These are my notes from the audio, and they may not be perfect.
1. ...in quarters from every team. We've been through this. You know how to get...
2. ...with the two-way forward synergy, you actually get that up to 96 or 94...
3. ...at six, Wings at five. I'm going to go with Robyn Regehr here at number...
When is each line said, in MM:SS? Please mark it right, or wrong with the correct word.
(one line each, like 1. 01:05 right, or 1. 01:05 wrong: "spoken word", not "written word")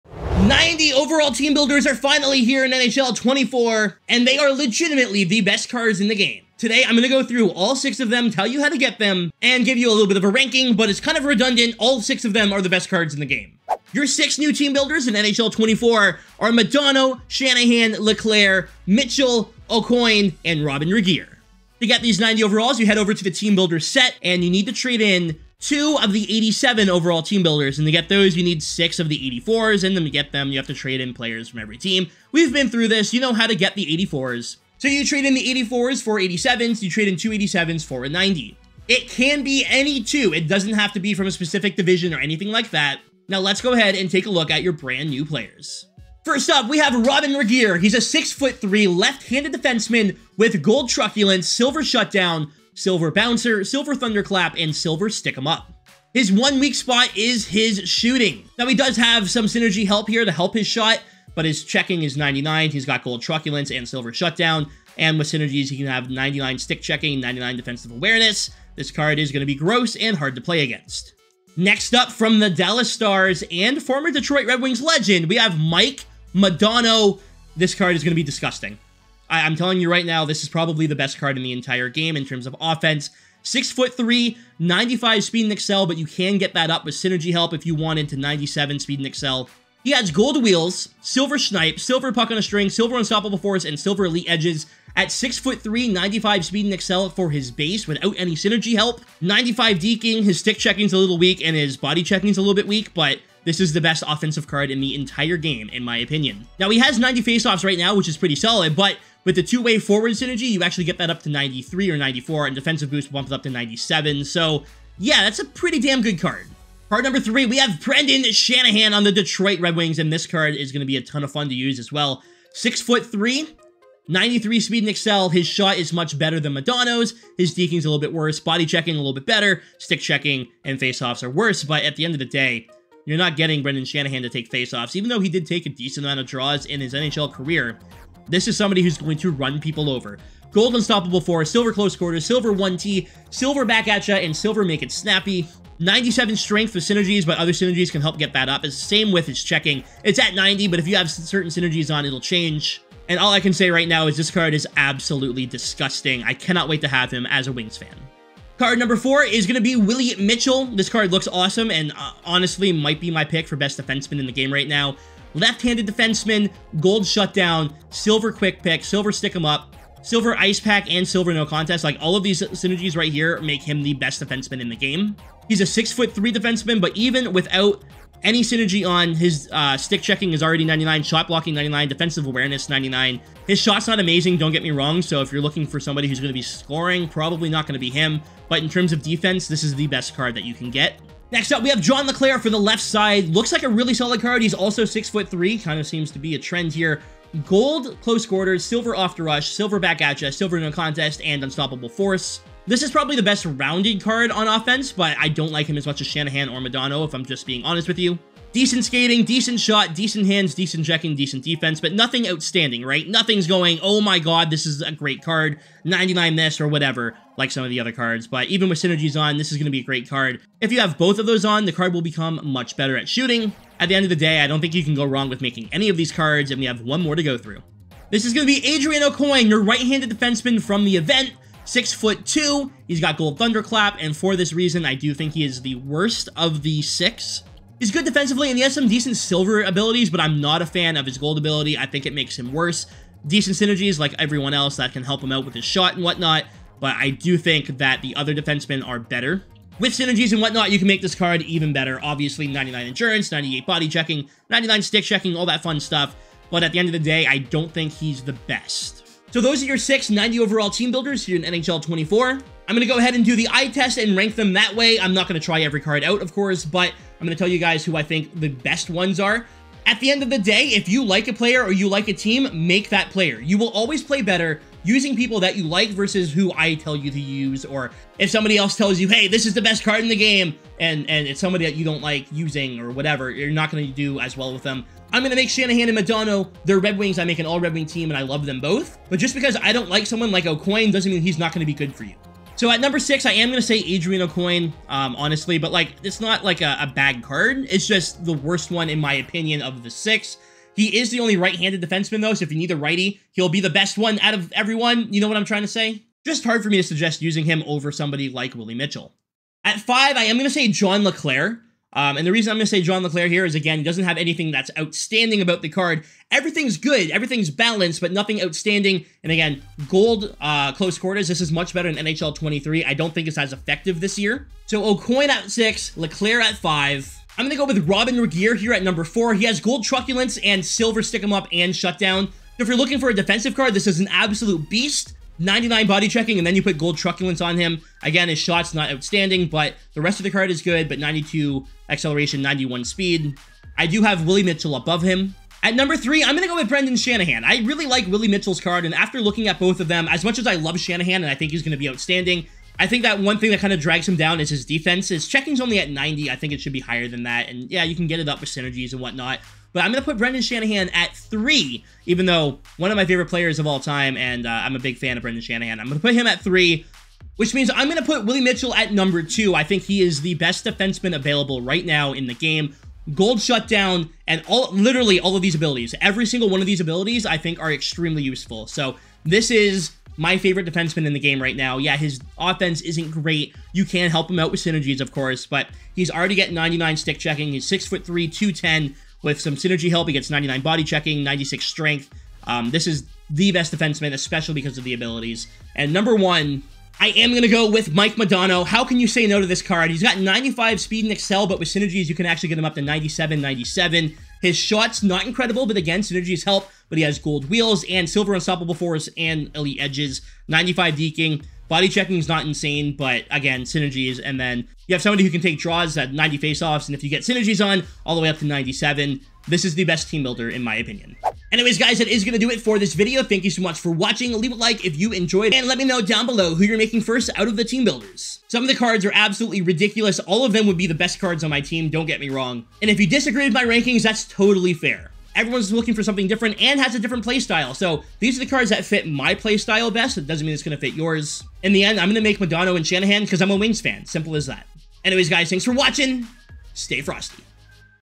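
1. 00:30 wrong: "players", not "quarters"
2. 01:49 wrong: "93", not "96"
3. 05:25 wrong: "LeClair", not "Wings".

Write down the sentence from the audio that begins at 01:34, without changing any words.
At 6 foot 3, 95 speed and accel for his base without any synergy help.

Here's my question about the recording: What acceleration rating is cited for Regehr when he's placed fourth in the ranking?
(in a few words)
92.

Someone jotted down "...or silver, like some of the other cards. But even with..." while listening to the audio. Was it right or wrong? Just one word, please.
wrong.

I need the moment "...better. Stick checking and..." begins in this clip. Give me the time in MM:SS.
02:09.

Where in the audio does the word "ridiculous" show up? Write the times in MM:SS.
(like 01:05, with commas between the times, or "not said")
07:09.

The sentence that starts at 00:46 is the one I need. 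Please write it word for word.
First up, we have Robyn Regehr.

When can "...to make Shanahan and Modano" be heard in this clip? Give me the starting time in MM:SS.
04:45.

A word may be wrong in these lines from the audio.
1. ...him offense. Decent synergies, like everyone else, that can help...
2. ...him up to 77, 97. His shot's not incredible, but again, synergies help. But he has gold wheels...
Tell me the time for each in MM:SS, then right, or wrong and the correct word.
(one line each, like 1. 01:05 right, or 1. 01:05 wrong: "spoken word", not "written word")
1. 04:02 wrong: "worse", not "offense"
2. 06:42 wrong: "97", not "77".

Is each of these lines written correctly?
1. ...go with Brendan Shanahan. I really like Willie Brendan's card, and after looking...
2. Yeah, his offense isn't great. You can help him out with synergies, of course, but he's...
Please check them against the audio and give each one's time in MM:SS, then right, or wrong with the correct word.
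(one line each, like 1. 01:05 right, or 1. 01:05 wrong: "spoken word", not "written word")
1. 05:46 wrong: "Mitchell", not "Brendan"
2. 06:21 right.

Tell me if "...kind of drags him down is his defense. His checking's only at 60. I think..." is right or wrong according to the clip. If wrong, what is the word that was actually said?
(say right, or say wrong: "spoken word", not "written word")
wrong: "90", not "60".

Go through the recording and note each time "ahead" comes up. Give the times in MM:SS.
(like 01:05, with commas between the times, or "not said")
00:43, 04:22.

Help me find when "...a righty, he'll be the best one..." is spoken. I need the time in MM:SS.
05:02.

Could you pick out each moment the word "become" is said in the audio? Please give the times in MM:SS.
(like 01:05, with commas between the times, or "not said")
03:42.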